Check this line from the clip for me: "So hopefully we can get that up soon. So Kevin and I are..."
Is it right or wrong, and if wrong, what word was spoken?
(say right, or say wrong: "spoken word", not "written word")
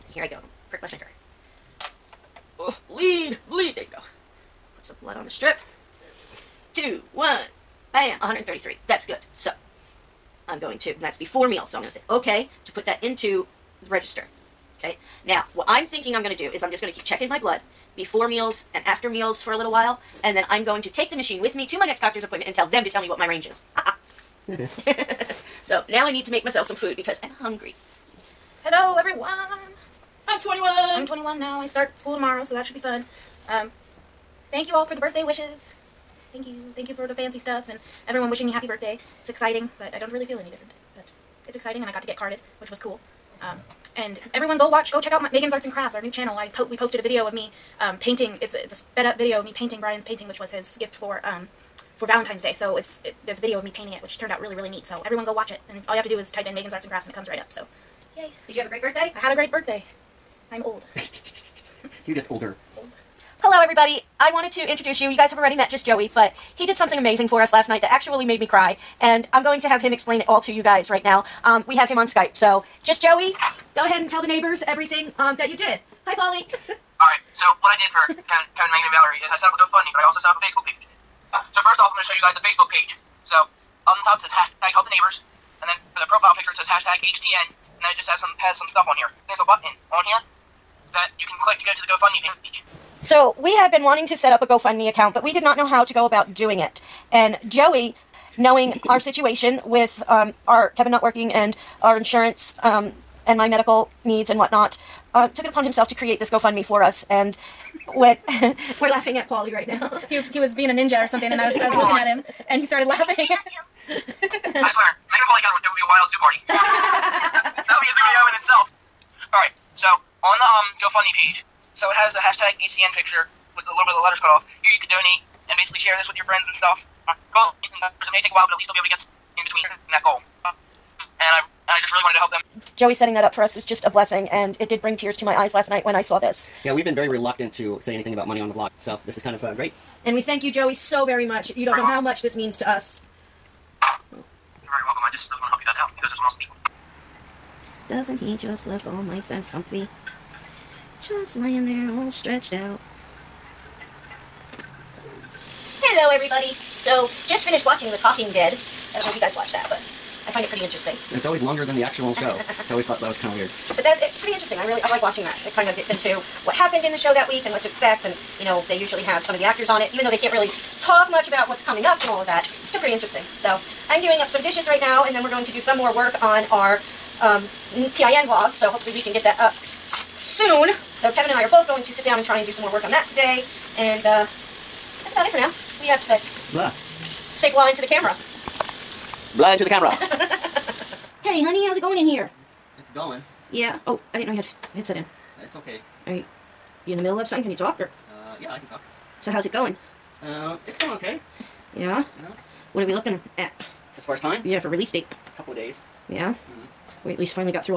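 right.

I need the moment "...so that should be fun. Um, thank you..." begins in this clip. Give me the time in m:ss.
0:32.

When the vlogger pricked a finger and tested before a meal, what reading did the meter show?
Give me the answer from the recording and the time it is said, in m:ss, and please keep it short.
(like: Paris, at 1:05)
133, at 0:08.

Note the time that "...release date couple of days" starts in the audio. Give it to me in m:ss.
3:24.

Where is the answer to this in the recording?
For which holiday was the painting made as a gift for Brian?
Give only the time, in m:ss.
0:52.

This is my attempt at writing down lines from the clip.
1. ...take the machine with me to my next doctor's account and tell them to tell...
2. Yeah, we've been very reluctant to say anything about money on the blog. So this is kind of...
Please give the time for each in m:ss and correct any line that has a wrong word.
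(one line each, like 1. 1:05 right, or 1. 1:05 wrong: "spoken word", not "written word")
1. 0:20 wrong: "appointment", not "account"
2. 2:16 right.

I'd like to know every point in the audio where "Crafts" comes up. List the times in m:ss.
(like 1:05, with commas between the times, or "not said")
0:45, 0:56.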